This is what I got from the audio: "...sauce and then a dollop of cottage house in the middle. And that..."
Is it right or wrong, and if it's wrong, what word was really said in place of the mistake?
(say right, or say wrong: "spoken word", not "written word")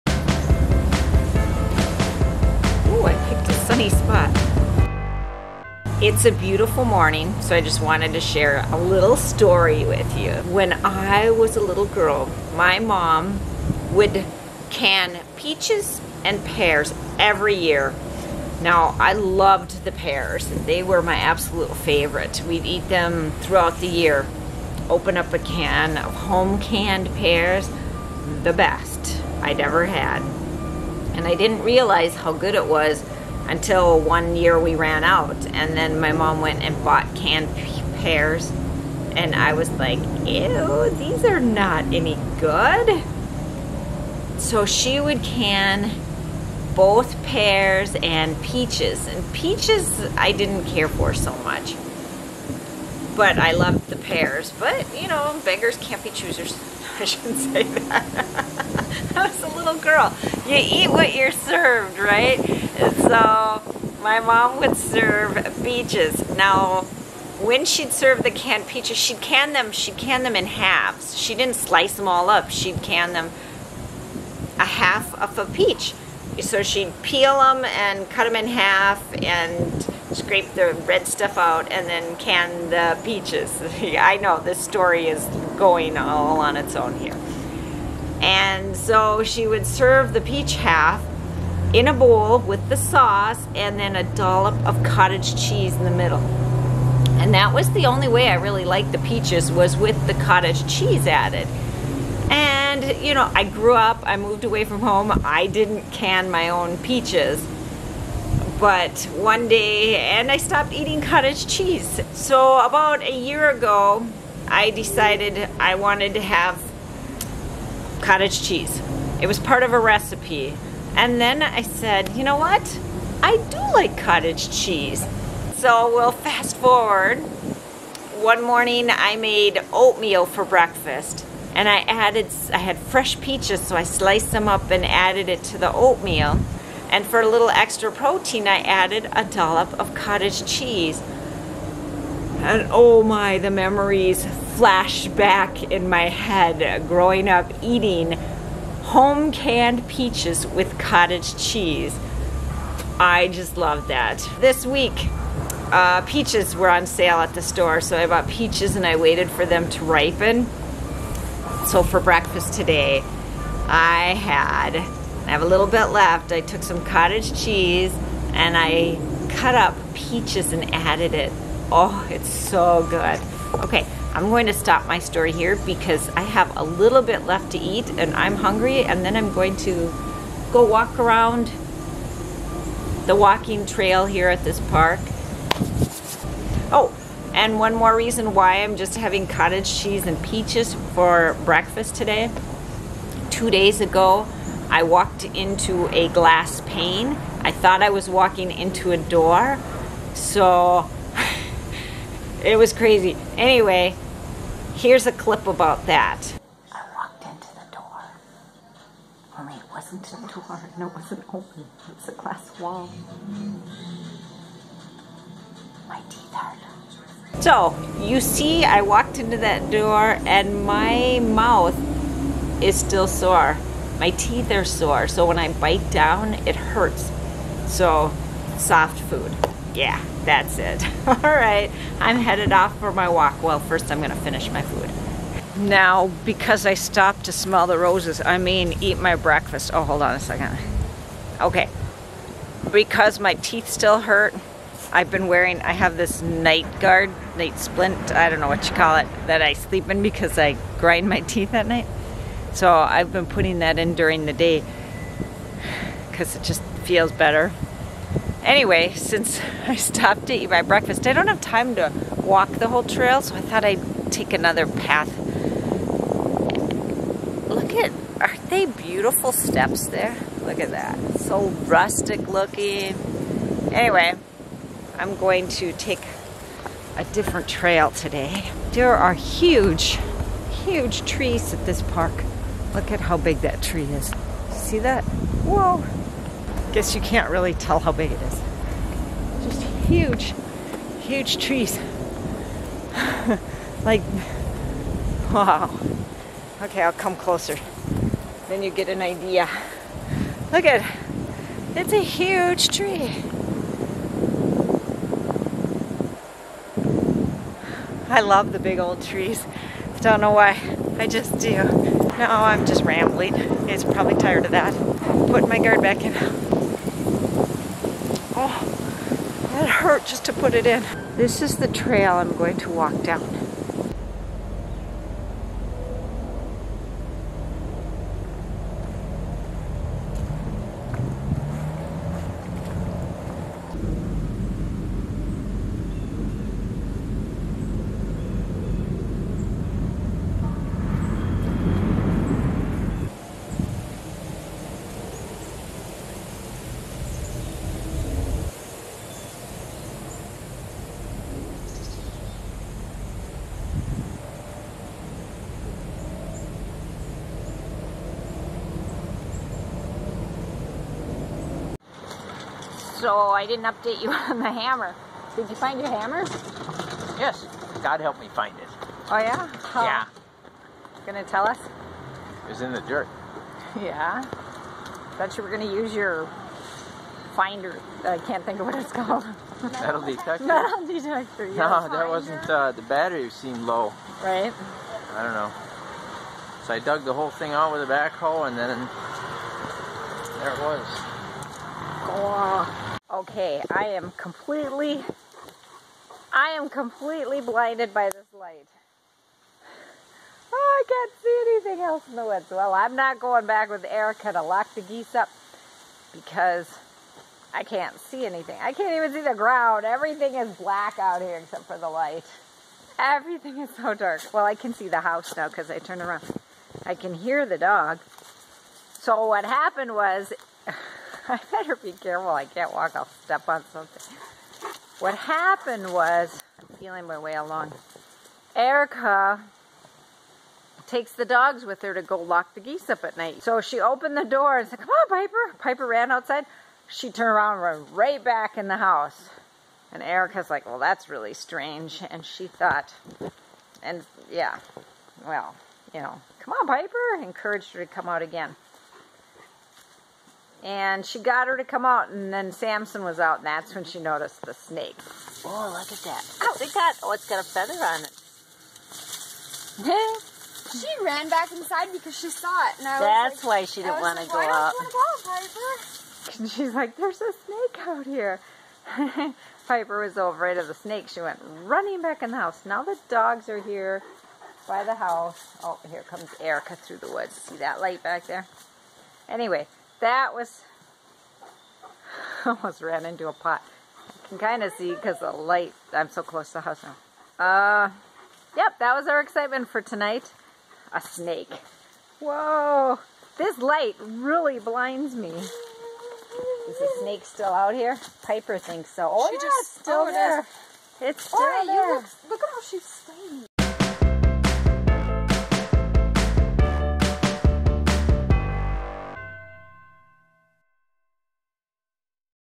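wrong: "cheese", not "house".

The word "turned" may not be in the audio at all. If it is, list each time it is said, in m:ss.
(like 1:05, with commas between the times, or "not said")
6:55, 7:17.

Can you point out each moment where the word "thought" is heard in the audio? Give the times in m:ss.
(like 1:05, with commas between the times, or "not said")
3:17, 4:23, 6:15, 7:22.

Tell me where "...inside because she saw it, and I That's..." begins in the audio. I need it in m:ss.
7:41.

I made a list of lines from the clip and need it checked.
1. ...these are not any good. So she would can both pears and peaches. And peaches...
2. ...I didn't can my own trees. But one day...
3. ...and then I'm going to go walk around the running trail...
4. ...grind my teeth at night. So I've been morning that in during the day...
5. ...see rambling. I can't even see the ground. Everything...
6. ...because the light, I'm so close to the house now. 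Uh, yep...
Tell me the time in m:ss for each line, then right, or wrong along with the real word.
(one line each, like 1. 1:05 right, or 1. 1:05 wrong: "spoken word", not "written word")
1. 0:40 right
2. 1:45 wrong: "peaches", not "trees"
3. 2:58 wrong: "walking", not "running"
4. 4:10 wrong: "putting", not "morning"
5. 6:47 wrong: "anything", not "rambling"
6. 8:04 right.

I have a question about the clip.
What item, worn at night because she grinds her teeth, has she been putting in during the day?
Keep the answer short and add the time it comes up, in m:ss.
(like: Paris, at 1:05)
night guard, at 4:06.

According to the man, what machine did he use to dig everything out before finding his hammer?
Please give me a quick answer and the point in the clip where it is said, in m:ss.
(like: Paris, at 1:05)
backhoe, at 6:27.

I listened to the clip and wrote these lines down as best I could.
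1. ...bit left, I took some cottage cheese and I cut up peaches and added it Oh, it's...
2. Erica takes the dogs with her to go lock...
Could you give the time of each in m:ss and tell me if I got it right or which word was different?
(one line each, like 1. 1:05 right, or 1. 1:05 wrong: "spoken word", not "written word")
1. 2:45 right
2. 7:08 right.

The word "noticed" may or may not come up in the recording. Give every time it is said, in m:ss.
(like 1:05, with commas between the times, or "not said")
7:33.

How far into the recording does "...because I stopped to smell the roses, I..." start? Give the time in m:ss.
3:56.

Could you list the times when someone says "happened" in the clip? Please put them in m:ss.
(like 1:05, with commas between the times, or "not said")
6:59, 7:05.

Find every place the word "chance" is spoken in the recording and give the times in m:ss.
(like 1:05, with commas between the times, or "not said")
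not said.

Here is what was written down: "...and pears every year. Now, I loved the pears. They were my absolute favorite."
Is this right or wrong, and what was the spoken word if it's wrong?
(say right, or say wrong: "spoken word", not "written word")
right.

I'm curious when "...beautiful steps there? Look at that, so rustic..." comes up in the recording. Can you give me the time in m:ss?
4:28.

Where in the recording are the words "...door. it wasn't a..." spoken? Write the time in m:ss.
3:27.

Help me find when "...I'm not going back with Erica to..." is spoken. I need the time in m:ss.
6:42.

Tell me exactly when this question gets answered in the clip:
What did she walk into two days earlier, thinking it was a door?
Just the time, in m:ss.
3:16.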